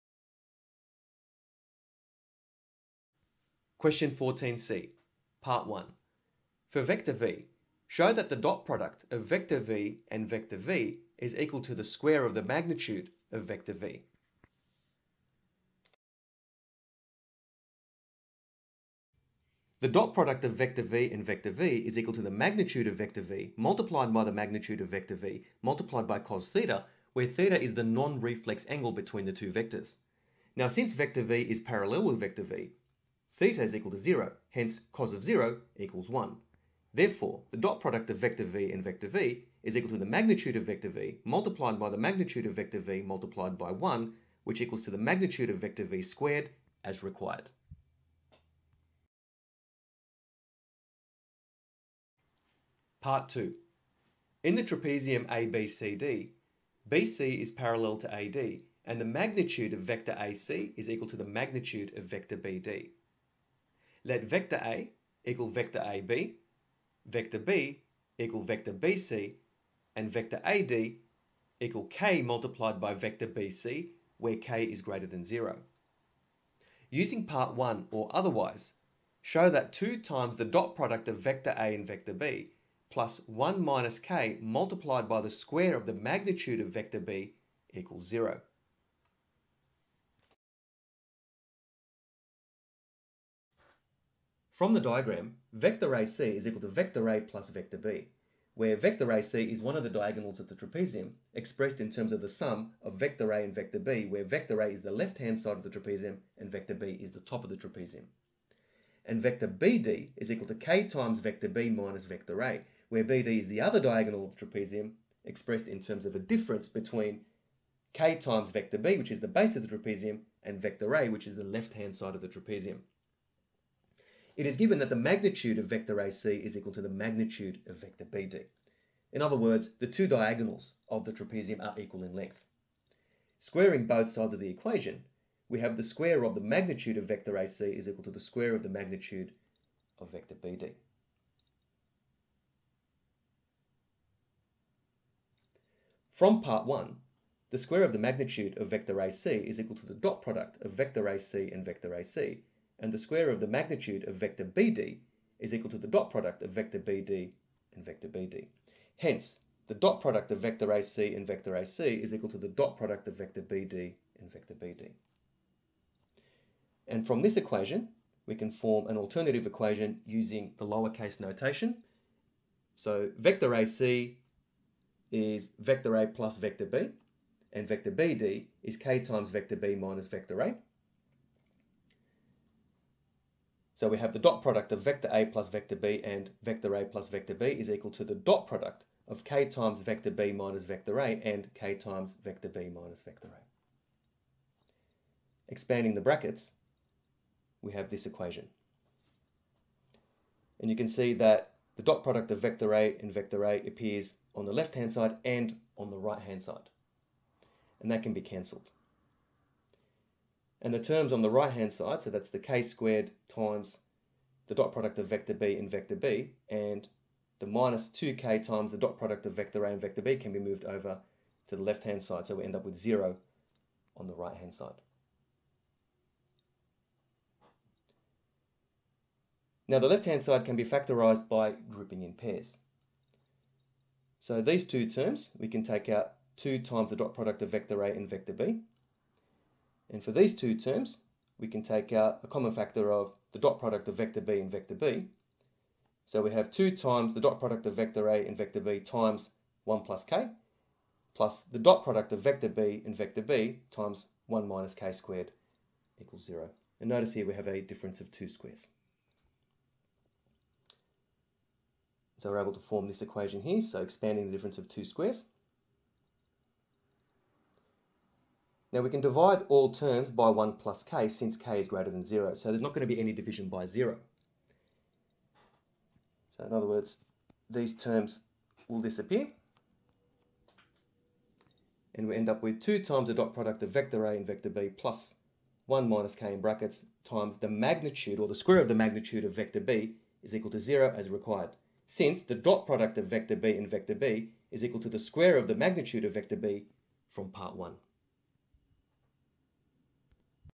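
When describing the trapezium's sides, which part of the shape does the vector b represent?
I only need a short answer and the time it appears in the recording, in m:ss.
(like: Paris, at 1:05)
the top, at 1:47.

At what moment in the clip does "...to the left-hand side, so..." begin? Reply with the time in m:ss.
3:41.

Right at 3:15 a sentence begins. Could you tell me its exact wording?
Expanding the brackets, we have this equation.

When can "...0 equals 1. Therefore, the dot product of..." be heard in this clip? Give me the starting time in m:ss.
0:35.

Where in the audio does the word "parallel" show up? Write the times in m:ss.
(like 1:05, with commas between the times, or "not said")
0:31, 0:57.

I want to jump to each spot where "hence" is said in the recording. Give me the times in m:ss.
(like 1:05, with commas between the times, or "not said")
0:34, 2:38.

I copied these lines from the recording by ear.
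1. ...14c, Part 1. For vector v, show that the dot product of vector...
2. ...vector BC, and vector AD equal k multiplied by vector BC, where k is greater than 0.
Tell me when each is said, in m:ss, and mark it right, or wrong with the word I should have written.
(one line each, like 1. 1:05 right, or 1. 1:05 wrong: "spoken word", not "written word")
1. 0:04 right
2. 1:08 right.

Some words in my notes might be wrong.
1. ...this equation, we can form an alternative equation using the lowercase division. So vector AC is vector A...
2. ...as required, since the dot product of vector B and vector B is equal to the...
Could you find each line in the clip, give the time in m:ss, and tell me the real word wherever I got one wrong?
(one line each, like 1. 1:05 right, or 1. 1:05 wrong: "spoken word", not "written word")
1. 2:47 wrong: "notation", not "division"
2. 4:50 right.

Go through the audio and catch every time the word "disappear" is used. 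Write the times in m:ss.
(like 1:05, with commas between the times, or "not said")
4:38.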